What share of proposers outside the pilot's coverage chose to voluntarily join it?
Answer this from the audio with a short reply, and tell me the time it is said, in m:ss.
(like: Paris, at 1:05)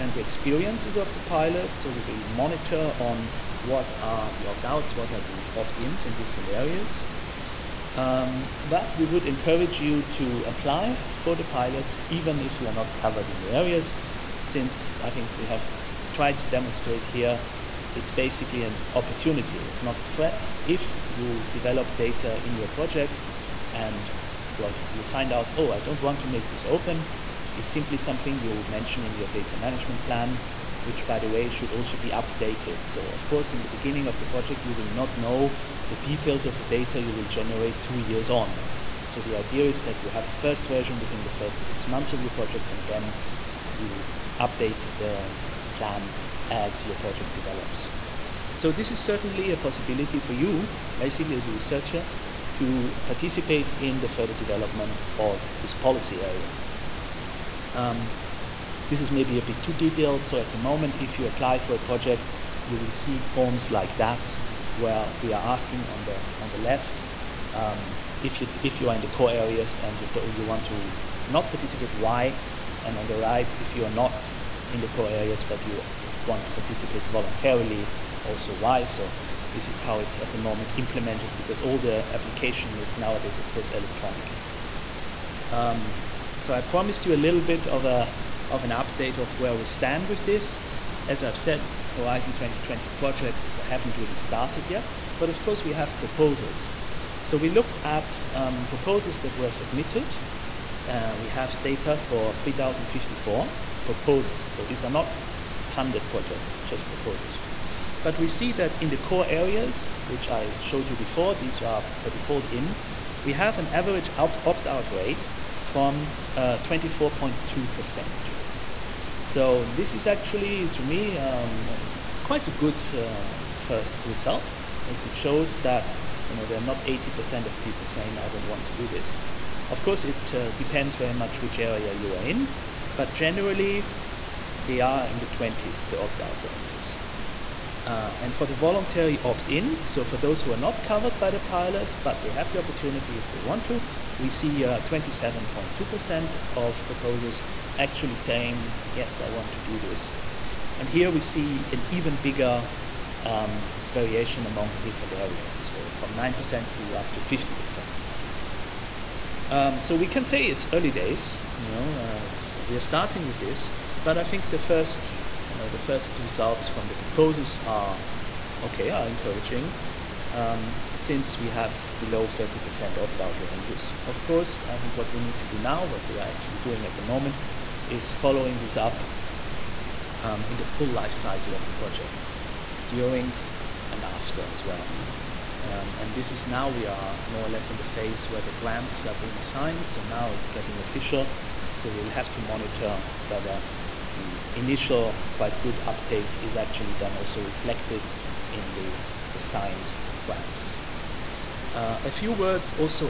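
27.2%, at 2:24.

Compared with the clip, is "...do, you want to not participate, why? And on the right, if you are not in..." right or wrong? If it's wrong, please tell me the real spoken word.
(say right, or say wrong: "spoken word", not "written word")
right.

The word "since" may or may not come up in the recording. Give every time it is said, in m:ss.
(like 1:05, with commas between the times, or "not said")
0:14, 2:50.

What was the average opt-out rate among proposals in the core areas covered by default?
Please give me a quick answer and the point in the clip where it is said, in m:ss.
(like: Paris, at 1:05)
24.2%, at 1:56.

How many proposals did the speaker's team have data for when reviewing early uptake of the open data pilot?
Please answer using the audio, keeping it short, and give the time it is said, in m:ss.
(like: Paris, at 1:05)
3,054, at 1:42.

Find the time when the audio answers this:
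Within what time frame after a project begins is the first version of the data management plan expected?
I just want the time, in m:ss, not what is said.
0:41.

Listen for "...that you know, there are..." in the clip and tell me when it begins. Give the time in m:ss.
2:05.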